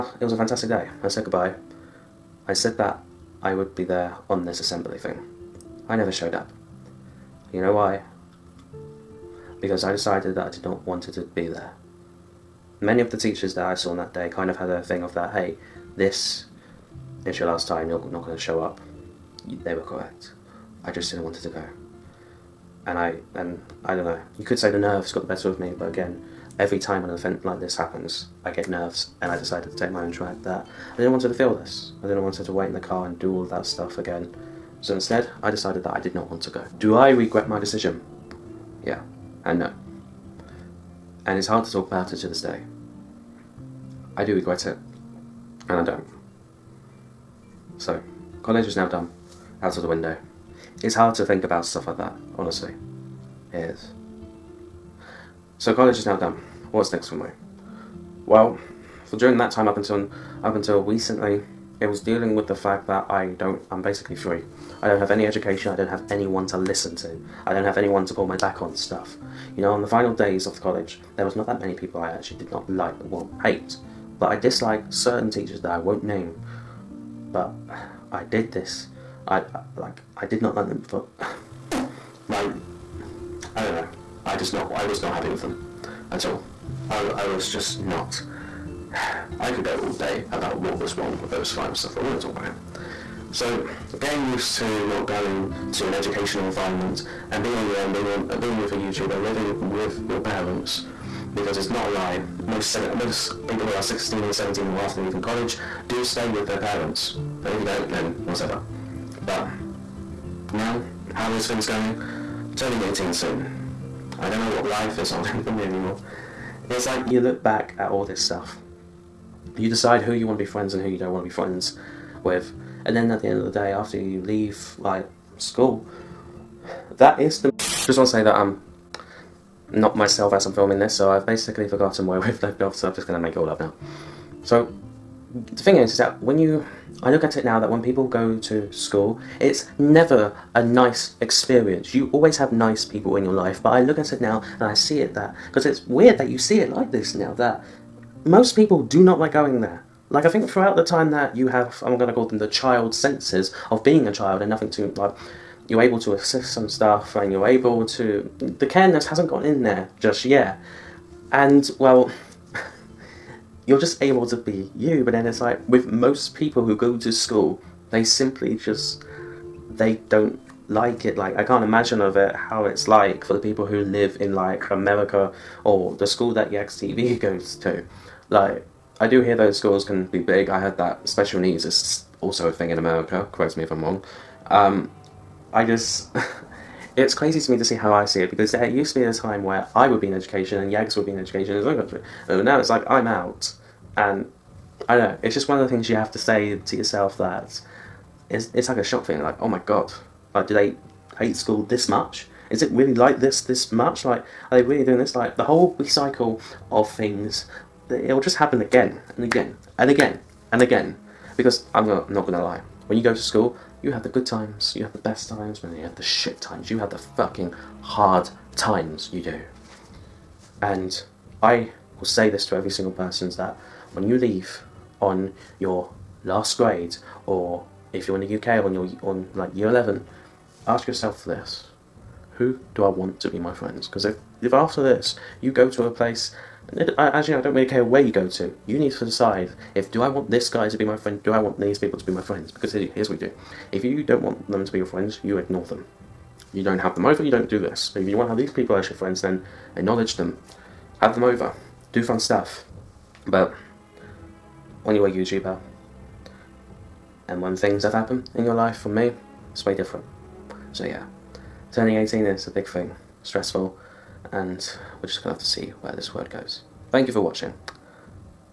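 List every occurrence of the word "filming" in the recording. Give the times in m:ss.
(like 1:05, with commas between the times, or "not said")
2:10.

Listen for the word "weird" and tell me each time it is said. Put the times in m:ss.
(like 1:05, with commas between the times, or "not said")
2:25.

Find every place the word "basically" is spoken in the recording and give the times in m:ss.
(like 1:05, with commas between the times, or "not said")
1:03, 2:11.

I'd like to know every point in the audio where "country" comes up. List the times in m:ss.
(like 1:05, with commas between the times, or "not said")
3:11.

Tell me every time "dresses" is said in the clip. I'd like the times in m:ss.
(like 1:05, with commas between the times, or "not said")
not said.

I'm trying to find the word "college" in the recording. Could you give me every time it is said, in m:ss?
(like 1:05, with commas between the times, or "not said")
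0:48, 0:55, 1:10, 1:45.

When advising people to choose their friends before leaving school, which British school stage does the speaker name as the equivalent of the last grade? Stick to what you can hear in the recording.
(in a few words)
Year 11.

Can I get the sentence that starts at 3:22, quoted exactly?
Is it really like this this much?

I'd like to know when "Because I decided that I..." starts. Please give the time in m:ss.
0:09.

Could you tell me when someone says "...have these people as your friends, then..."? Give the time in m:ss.
4:08.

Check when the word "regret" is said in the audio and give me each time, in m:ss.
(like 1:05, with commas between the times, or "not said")
0:37, 0:44.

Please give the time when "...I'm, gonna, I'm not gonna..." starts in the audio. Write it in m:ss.
3:31.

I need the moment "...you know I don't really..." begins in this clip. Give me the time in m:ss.
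3:57.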